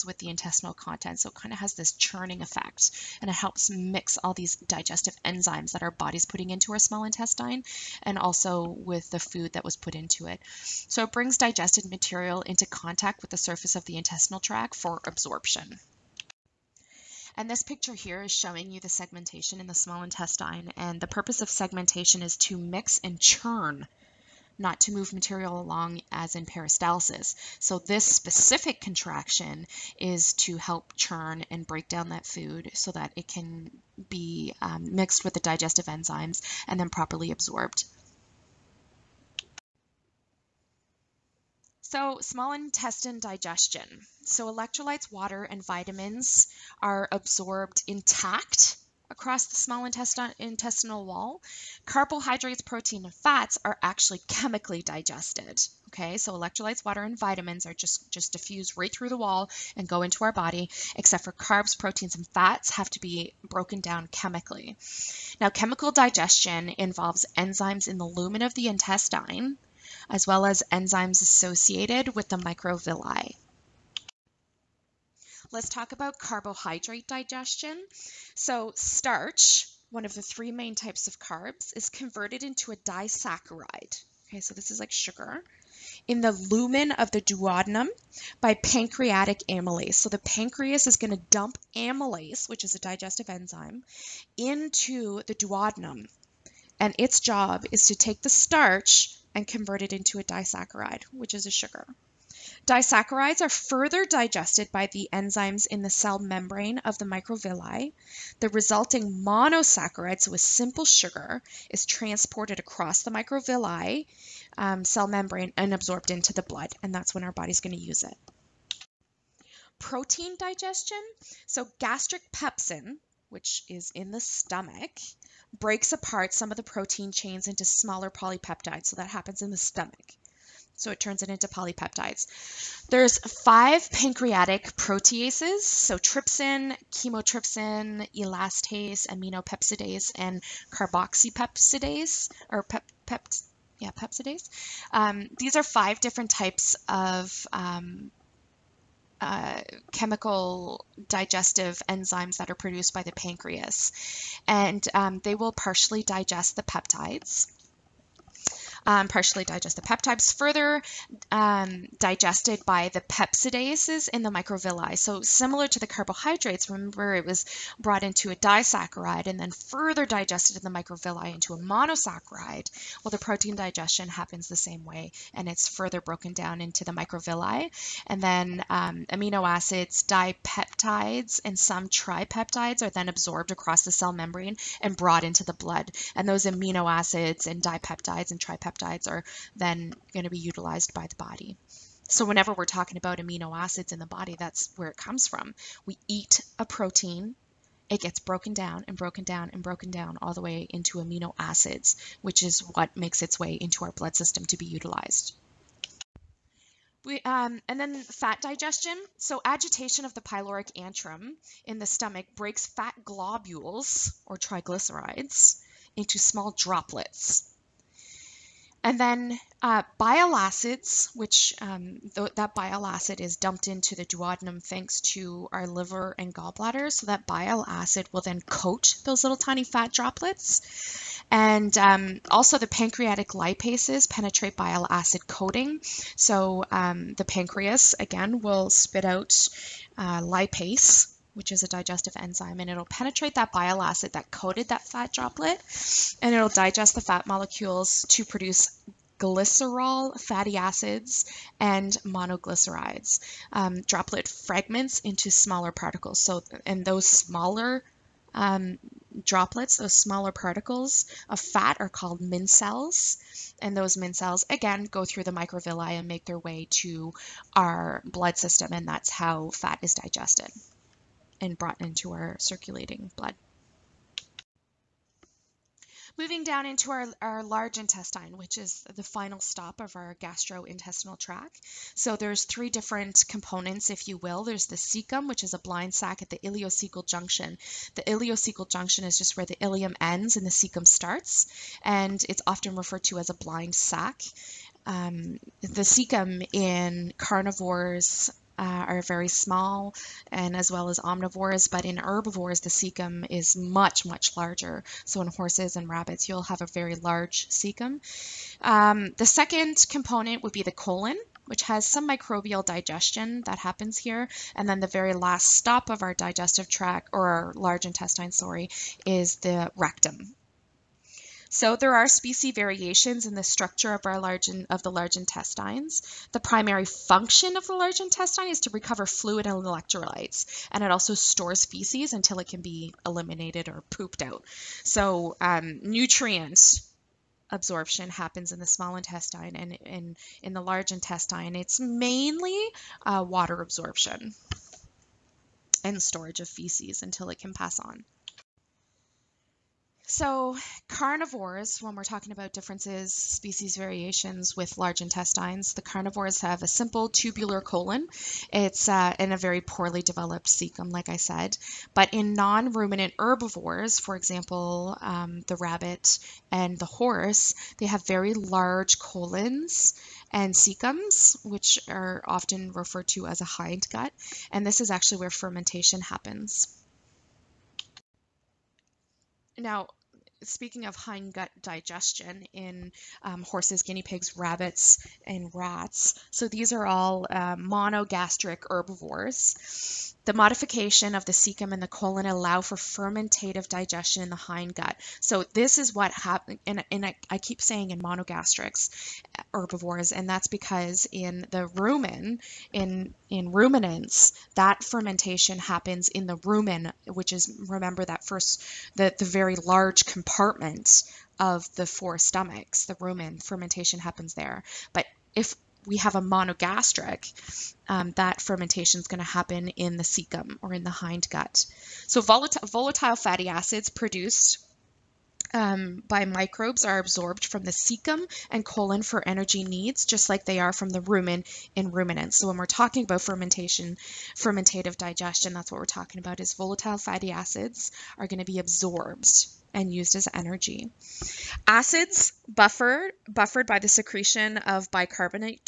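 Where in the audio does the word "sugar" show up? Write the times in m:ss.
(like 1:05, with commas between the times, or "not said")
1:24, 1:41, 1:50.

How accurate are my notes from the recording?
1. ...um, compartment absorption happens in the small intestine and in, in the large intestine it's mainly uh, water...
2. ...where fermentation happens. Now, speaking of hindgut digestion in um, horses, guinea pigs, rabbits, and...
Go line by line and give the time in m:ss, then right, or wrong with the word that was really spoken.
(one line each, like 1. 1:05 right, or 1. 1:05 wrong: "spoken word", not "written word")
1. 5:35 wrong: "nutrient", not "compartment"
2. 6:15 right.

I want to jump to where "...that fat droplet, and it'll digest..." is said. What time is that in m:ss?
4:04.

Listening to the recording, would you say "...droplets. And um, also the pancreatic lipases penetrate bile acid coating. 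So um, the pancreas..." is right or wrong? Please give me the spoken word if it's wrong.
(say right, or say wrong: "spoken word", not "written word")
right.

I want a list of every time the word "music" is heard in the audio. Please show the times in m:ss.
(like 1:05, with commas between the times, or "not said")
not said.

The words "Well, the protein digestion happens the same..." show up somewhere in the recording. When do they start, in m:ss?
2:53.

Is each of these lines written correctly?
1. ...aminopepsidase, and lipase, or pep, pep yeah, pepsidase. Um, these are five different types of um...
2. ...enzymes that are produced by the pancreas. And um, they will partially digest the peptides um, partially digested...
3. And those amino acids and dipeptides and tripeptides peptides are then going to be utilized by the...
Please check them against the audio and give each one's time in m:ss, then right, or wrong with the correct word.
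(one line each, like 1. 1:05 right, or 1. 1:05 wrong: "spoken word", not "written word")
1. 2:19 wrong: "carboxypepsidase", not "lipase"
2. 2:31 right
3. 3:06 right.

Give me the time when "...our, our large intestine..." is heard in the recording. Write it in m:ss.
4:36.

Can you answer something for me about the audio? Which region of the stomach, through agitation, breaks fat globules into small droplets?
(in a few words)
pyloric antrum.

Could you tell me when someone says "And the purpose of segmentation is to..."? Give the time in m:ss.
0:20.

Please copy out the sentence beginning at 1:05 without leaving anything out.
Now, chemical digestion involves enzymes in the lumen of the intestine as well as enzymes associated with the microvilli.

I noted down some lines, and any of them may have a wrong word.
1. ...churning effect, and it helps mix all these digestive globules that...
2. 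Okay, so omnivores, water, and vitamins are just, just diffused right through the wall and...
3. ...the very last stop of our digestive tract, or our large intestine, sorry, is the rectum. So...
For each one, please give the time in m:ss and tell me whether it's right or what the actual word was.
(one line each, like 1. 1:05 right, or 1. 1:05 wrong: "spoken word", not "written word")
1. 0:01 wrong: "enzymes", not "globules"
2. 0:55 wrong: "electrolytes", not "omnivores"
3. 5:14 right.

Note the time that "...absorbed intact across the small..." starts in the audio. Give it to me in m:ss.
0:47.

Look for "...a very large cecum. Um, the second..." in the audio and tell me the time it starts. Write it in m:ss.
5:06.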